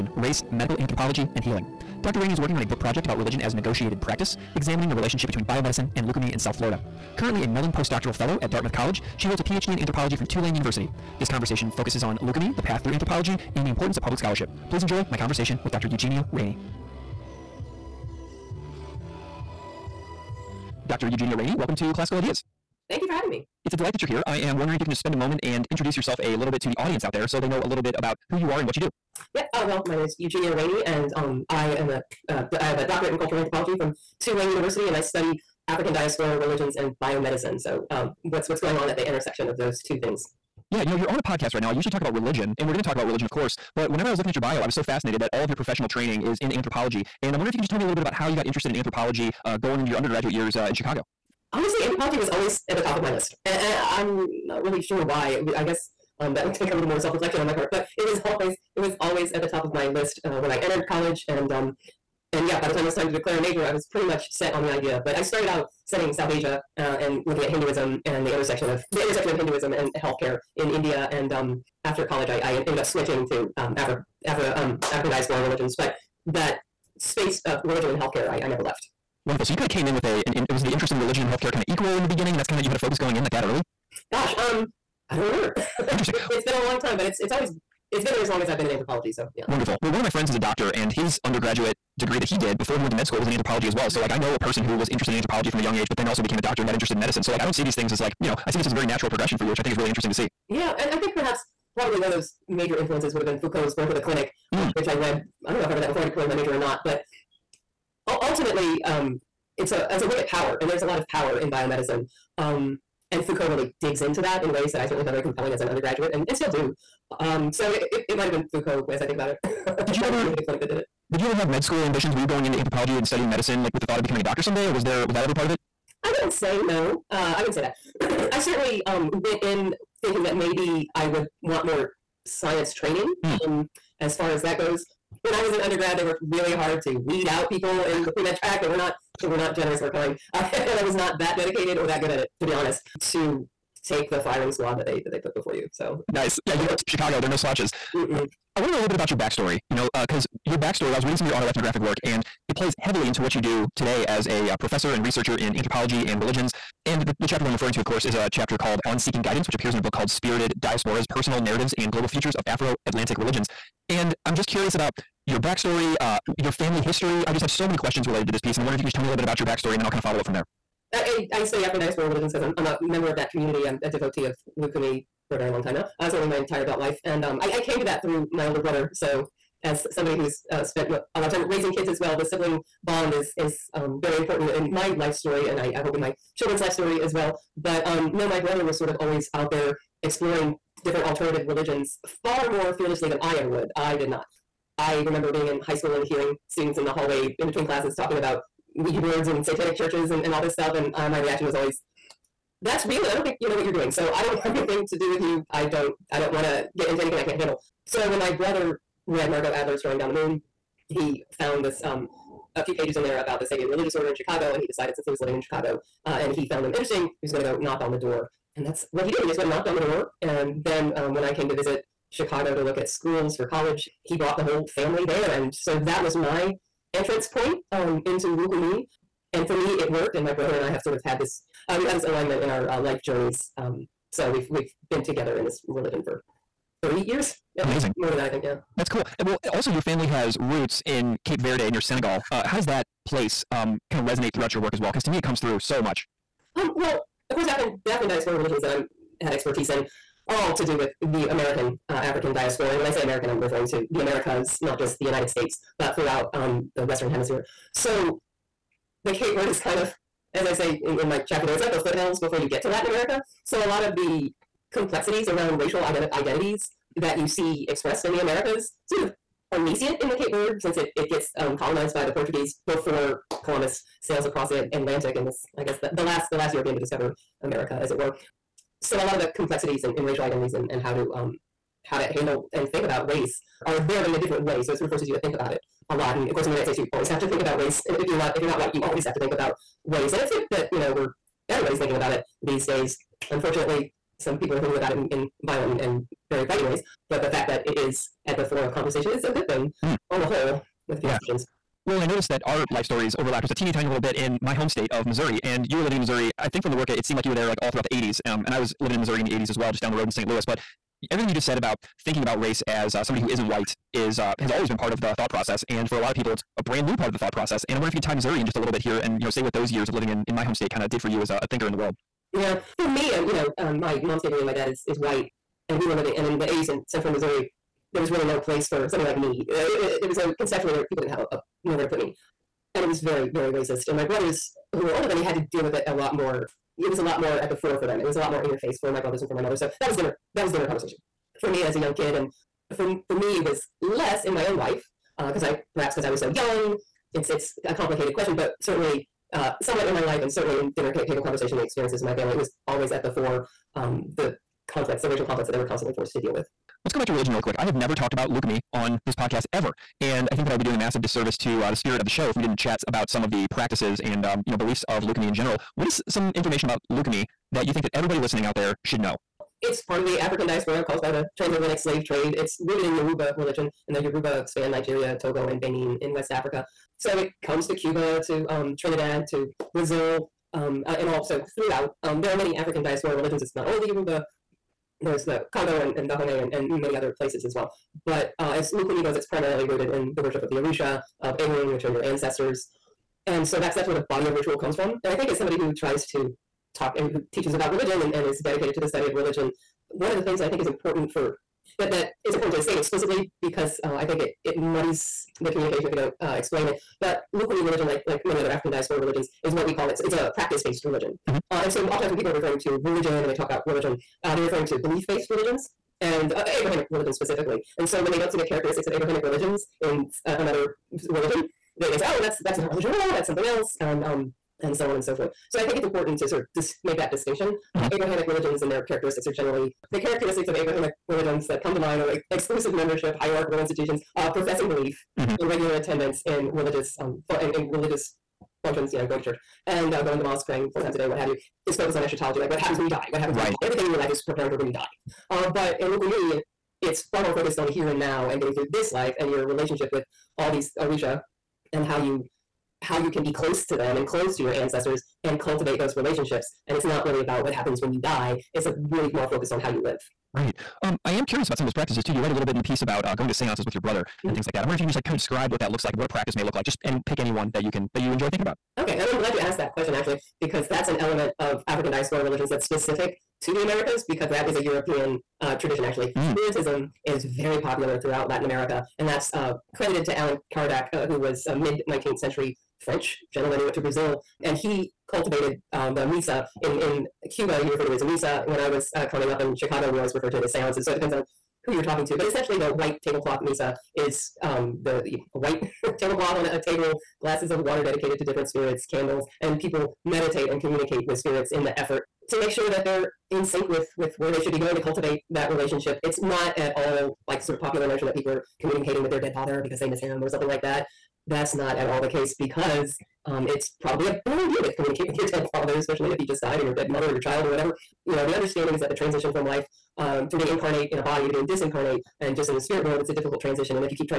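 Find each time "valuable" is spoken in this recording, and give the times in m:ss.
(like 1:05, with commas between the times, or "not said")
not said.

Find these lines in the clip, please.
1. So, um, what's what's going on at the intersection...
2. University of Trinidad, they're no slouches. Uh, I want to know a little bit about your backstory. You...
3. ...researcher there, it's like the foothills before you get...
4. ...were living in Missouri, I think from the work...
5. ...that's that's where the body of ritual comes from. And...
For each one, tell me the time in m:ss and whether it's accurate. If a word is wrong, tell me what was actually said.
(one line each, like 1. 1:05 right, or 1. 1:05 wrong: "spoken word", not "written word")
1. 0:37 right
2. 2:26 wrong: "Chicago", not "Trinidad"
3. 4:21 wrong: "chapter", not "researcher"
4. 5:05 right
5. 6:33 right.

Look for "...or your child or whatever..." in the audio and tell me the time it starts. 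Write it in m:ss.
8:37.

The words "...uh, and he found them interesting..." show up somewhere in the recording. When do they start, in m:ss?
3:36.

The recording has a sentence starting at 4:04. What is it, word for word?
Because to me, it comes through so much.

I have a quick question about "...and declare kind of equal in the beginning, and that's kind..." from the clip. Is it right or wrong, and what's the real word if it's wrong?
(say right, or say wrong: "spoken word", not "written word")
wrong: "healthcare", not "declare".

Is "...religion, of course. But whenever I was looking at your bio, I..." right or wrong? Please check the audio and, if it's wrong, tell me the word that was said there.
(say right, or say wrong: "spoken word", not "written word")
right.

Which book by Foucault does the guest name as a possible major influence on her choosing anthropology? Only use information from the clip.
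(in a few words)
Birth of the Clinic.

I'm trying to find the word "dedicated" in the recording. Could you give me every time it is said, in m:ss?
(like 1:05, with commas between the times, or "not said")
2:21, 6:38, 8:17.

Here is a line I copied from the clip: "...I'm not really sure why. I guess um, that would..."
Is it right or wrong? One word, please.
right.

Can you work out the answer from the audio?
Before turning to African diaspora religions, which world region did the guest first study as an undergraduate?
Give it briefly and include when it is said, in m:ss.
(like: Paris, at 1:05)
South Asia, at 1:06.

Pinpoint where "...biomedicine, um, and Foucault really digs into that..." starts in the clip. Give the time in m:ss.
1:51.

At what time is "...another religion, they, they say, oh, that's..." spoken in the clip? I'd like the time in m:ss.
7:00.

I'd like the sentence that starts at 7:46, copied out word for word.
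Just any pick any one that you can that you enjoy thinking about.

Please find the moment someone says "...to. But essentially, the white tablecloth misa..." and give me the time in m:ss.
8:12.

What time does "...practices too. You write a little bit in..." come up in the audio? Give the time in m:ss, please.
7:41.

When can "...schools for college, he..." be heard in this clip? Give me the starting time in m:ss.
3:42.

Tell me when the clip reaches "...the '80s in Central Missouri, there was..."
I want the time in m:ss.
5:26.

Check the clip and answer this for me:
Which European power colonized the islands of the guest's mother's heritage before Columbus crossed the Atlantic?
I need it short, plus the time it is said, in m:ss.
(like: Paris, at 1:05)
Portuguese, at 4:32.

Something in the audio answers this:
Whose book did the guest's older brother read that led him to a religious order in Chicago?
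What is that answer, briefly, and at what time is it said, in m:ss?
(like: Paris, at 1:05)
Margot Adler, at 3:29.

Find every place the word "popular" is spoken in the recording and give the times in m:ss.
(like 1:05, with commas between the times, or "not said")
7:57, 8:27.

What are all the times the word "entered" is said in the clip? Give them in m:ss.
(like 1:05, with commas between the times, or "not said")
1:00.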